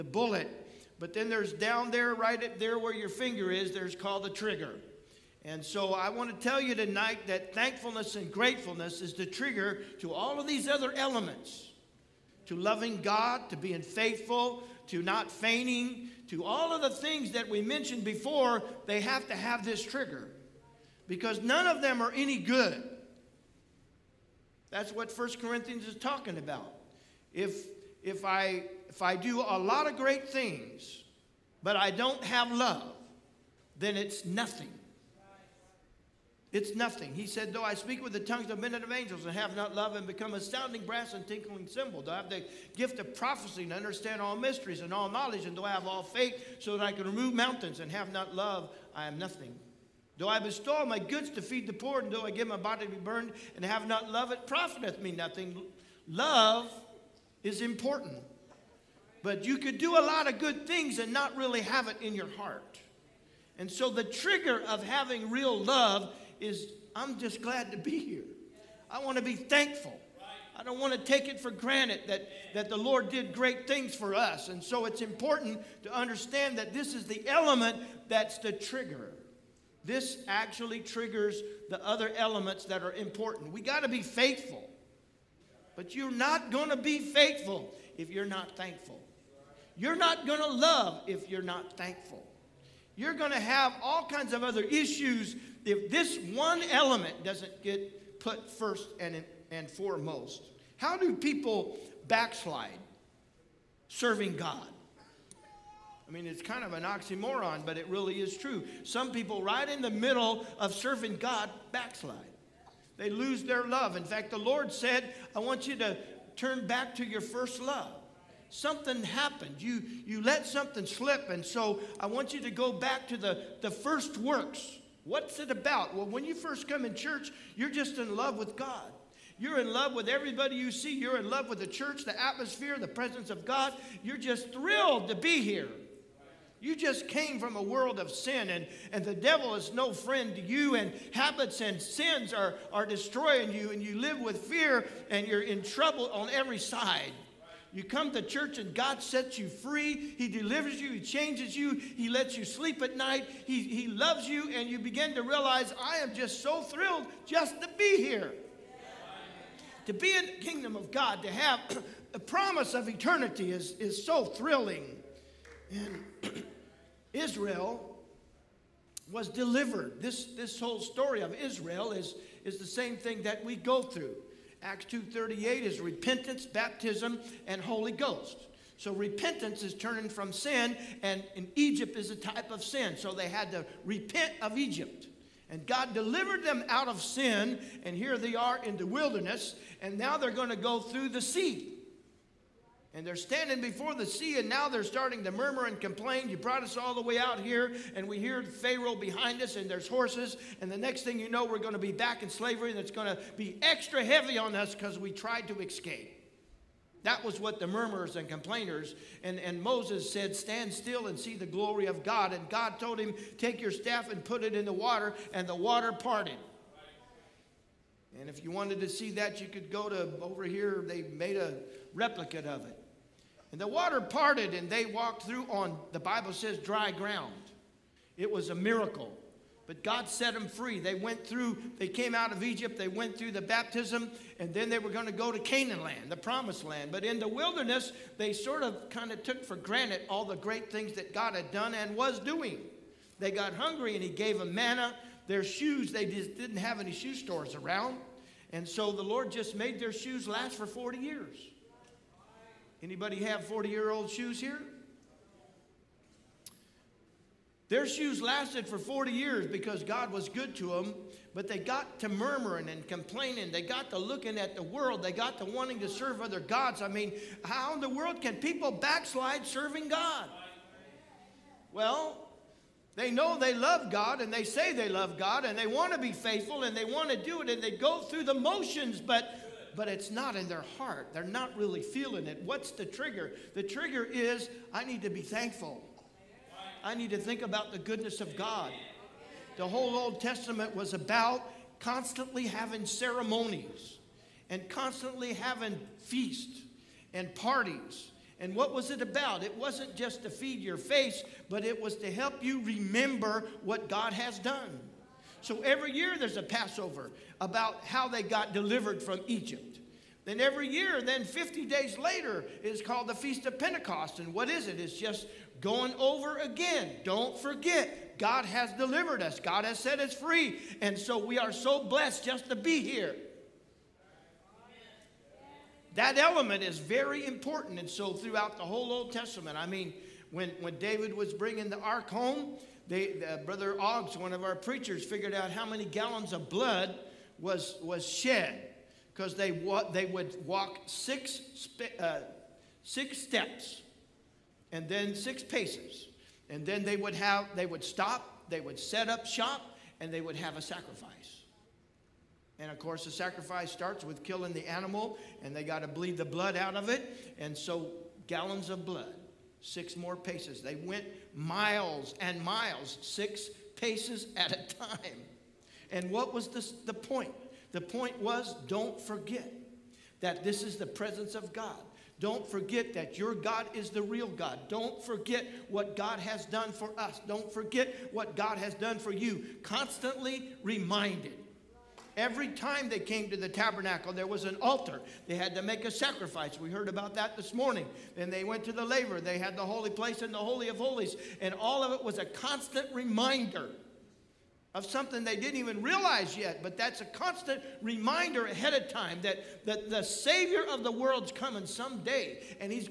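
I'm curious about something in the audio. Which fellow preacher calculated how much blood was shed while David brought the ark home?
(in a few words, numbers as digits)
Brother Oggs.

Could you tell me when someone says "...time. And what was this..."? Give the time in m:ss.
6:04.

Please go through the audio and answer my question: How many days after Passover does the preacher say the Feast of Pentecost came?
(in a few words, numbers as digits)
50.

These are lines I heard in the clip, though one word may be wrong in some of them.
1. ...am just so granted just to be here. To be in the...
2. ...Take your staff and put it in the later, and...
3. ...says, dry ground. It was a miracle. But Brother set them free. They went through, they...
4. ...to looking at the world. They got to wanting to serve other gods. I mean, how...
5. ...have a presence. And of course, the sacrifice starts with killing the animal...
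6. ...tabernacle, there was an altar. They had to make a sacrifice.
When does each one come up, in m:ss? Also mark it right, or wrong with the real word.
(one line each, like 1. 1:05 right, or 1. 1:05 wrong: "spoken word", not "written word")
1. 2:35 wrong: "thrilled", not "granted"
2. 3:33 wrong: "water", not "later"
3. 3:46 wrong: "God", not "Brother"
4. 4:23 right
5. 5:50 wrong: "sacrifice", not "presence"
6. 6:23 right.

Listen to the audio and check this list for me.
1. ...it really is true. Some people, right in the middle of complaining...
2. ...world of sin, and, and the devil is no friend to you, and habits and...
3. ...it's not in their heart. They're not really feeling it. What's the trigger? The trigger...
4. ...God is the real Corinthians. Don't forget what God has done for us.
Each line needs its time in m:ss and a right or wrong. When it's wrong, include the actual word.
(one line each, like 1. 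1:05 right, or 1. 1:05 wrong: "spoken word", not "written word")
1. 1:47 wrong: "serving", not "complaining"
2. 2:17 right
3. 4:39 right
4. 6:13 wrong: "God", not "Corinthians".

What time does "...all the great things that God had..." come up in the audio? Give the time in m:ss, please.
4:00.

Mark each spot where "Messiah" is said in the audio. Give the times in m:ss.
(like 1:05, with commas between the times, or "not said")
not said.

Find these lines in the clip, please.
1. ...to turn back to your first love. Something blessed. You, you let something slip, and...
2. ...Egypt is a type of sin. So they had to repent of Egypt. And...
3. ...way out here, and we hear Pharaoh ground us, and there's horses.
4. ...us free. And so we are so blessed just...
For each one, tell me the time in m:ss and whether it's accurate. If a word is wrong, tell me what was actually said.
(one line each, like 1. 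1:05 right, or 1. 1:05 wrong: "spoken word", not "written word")
1. 1:55 wrong: "happened", not "blessed"
2. 3:01 right
3. 3:17 wrong: "behind", not "ground"
4. 5:20 right.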